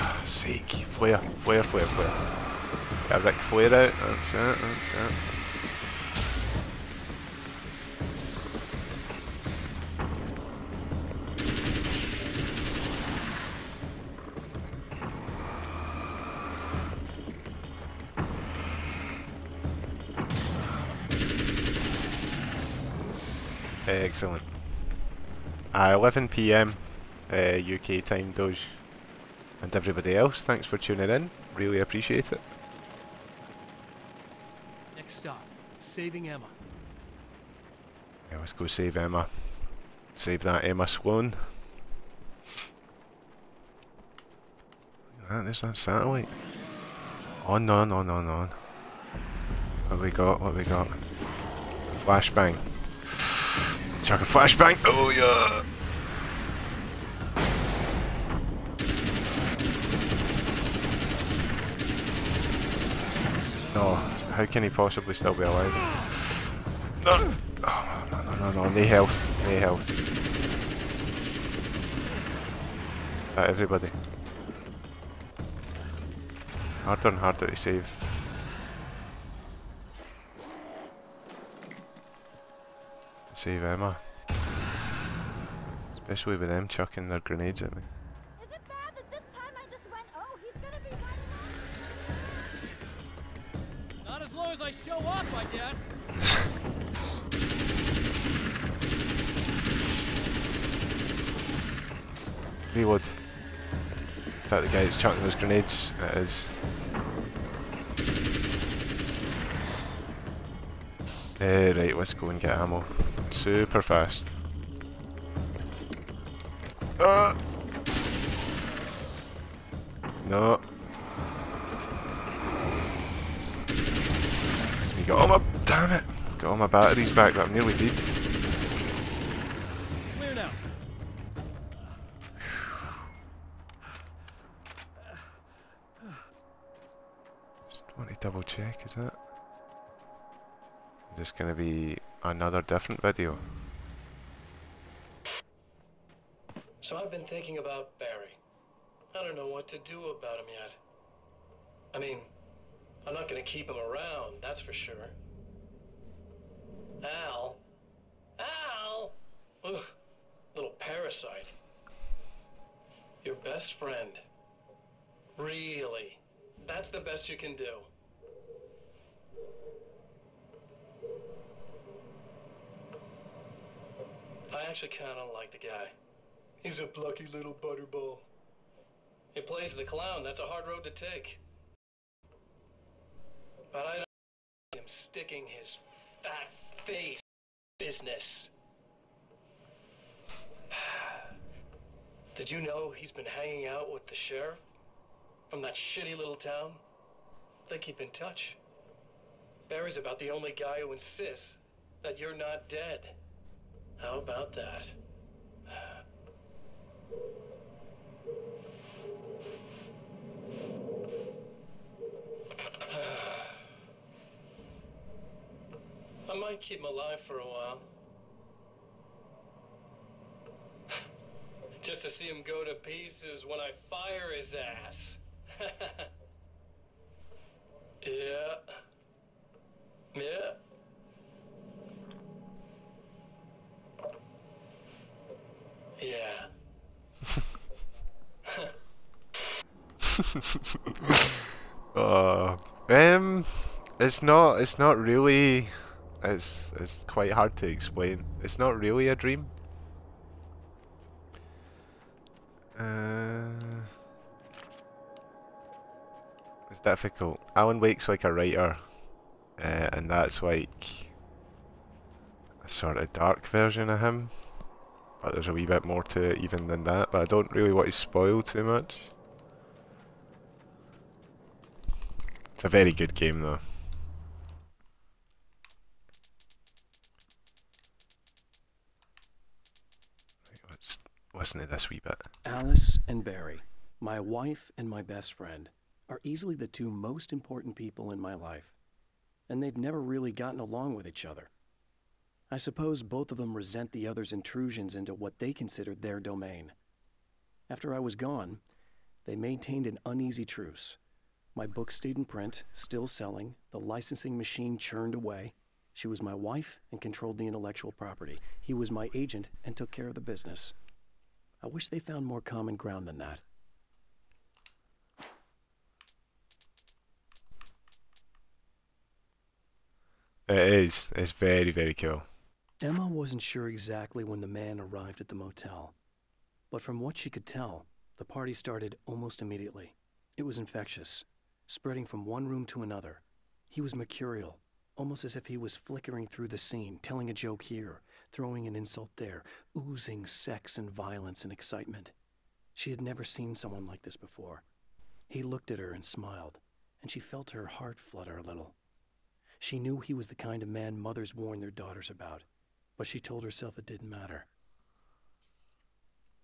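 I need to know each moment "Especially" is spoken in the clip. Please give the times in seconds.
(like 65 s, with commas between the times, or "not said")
85 s.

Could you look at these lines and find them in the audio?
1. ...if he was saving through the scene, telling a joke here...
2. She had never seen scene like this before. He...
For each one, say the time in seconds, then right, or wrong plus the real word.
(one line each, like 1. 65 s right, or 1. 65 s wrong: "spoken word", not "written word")
1. 335 s wrong: "flickering", not "saving"
2. 342 s wrong: "someone", not "scene".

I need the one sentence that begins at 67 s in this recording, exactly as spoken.
Oh, no, no, no, no, no, health, no health.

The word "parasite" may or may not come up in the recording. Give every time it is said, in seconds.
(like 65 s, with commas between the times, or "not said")
160 s.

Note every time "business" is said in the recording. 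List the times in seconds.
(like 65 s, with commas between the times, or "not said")
187 s, 310 s.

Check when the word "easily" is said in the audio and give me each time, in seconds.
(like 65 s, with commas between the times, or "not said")
286 s.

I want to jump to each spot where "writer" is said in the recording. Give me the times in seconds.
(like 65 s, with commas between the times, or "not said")
258 s.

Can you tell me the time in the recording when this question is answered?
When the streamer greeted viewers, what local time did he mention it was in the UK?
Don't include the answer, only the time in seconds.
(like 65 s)
25 s.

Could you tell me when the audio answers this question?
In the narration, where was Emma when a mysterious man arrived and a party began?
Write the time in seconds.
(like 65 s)
325 s.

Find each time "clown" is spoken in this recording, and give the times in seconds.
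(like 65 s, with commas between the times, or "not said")
179 s.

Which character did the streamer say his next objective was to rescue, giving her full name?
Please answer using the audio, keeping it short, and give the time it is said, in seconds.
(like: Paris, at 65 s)
Emma Sloan, at 40 s.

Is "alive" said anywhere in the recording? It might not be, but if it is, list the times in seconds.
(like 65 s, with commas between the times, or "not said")
65 s, 216 s.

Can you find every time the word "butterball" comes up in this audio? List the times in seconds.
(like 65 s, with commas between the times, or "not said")
177 s.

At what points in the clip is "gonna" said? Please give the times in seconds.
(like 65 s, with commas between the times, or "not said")
141 s, 153 s.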